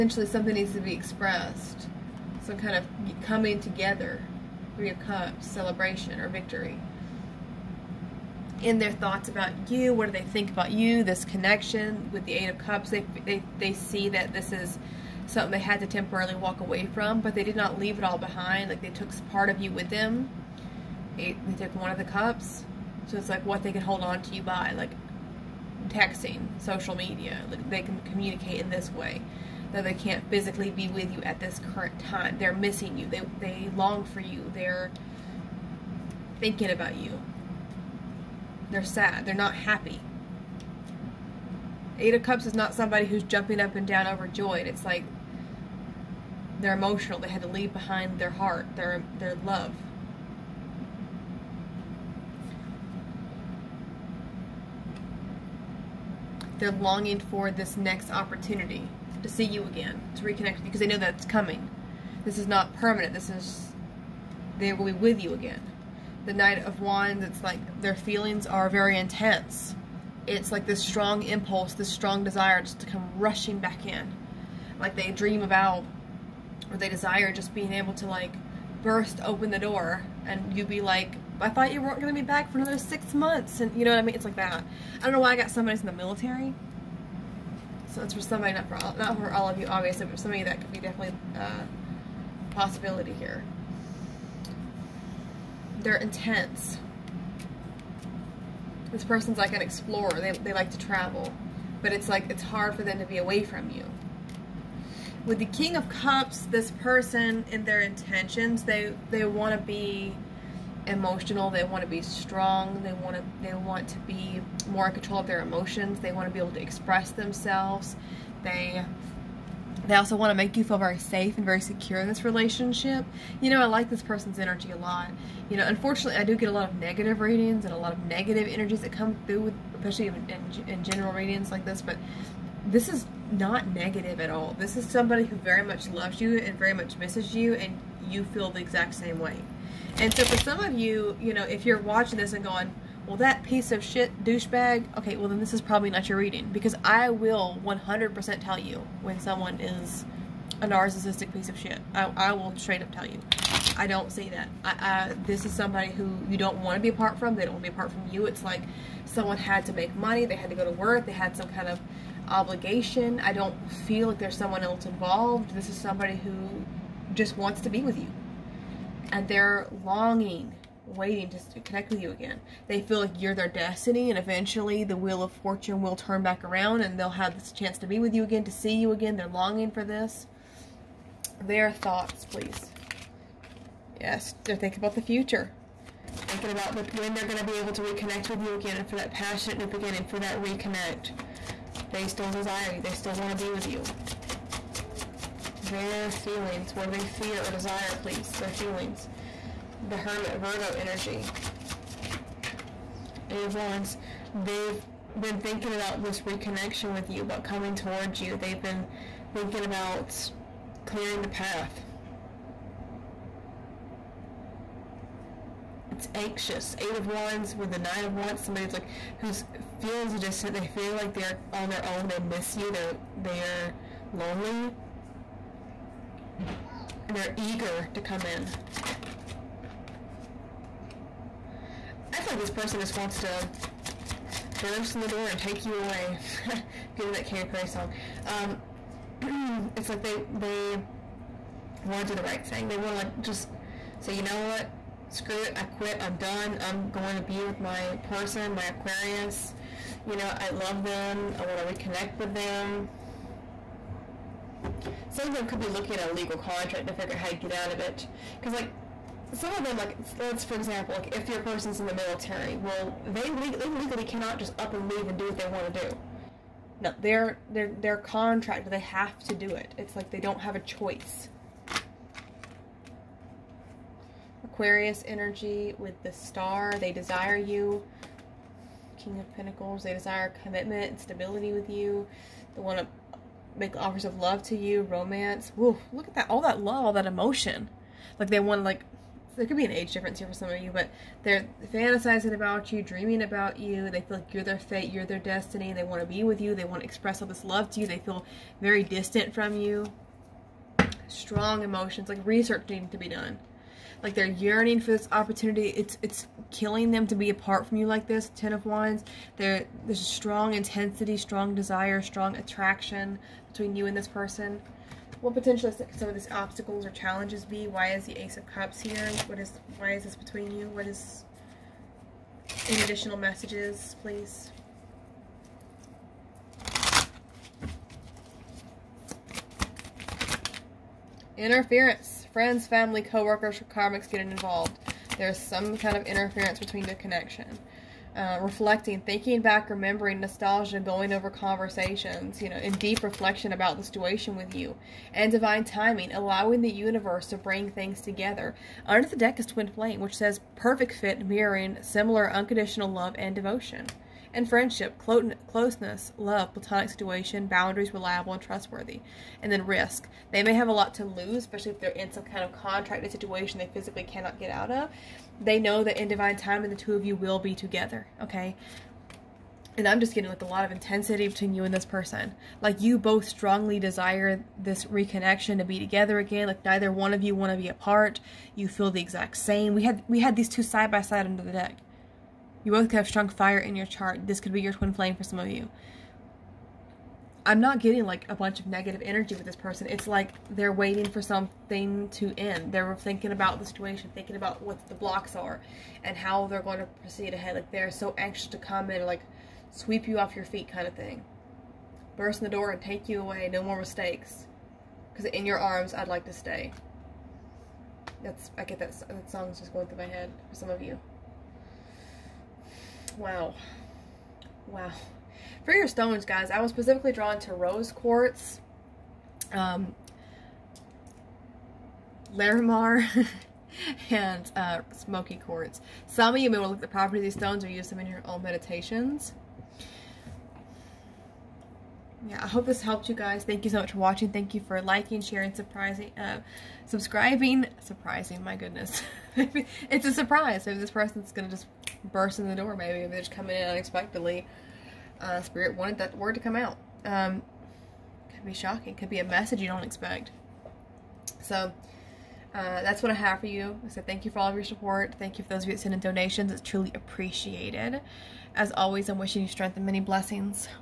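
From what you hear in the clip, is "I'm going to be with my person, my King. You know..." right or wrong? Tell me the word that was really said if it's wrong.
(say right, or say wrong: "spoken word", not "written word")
wrong: "Aquarius", not "King".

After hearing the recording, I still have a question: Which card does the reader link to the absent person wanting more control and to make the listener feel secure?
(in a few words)
King of Cups.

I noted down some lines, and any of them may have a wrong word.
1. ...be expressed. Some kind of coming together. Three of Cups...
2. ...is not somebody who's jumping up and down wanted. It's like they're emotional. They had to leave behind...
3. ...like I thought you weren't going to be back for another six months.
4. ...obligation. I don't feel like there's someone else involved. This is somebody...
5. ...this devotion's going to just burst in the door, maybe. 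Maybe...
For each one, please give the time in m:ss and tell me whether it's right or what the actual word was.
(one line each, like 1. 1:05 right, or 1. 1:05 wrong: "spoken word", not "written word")
1. 0:00 right
2. 0:42 wrong: "overjoyed", not "wanted"
3. 1:20 right
4. 2:42 right
5. 7:20 wrong: "person", not "devotion".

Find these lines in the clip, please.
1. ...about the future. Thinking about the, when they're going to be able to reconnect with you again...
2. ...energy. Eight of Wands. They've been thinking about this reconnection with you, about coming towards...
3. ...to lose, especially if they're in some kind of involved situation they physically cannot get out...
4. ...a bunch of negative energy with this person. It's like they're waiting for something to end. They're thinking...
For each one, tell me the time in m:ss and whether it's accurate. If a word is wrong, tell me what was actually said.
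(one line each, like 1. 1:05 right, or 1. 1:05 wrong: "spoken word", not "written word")
1. 3:04 right
2. 3:20 right
3. 6:00 wrong: "contracted", not "involved"
4. 6:28 right.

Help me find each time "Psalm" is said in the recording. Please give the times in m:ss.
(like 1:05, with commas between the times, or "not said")
not said.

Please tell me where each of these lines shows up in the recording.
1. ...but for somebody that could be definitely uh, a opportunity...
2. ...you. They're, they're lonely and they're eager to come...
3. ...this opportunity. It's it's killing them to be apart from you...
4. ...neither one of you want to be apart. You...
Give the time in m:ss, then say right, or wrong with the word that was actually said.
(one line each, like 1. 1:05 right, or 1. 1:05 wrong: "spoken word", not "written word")
1. 1:30 wrong: "possibility", not "opportunity"
2. 3:42 right
3. 5:04 right
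4. 6:16 right.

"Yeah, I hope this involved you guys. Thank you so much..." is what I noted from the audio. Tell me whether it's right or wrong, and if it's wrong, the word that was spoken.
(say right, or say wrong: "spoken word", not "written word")
wrong: "helped", not "involved".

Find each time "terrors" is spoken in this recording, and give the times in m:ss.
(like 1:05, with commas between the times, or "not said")
not said.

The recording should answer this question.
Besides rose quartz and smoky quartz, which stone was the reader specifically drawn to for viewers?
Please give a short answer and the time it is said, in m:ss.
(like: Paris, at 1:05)
Larimar, at 7:02.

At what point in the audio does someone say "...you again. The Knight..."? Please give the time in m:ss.
1:05.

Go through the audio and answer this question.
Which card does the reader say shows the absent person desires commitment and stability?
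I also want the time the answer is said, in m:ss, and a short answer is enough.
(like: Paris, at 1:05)
King of Pentacles, at 4:38.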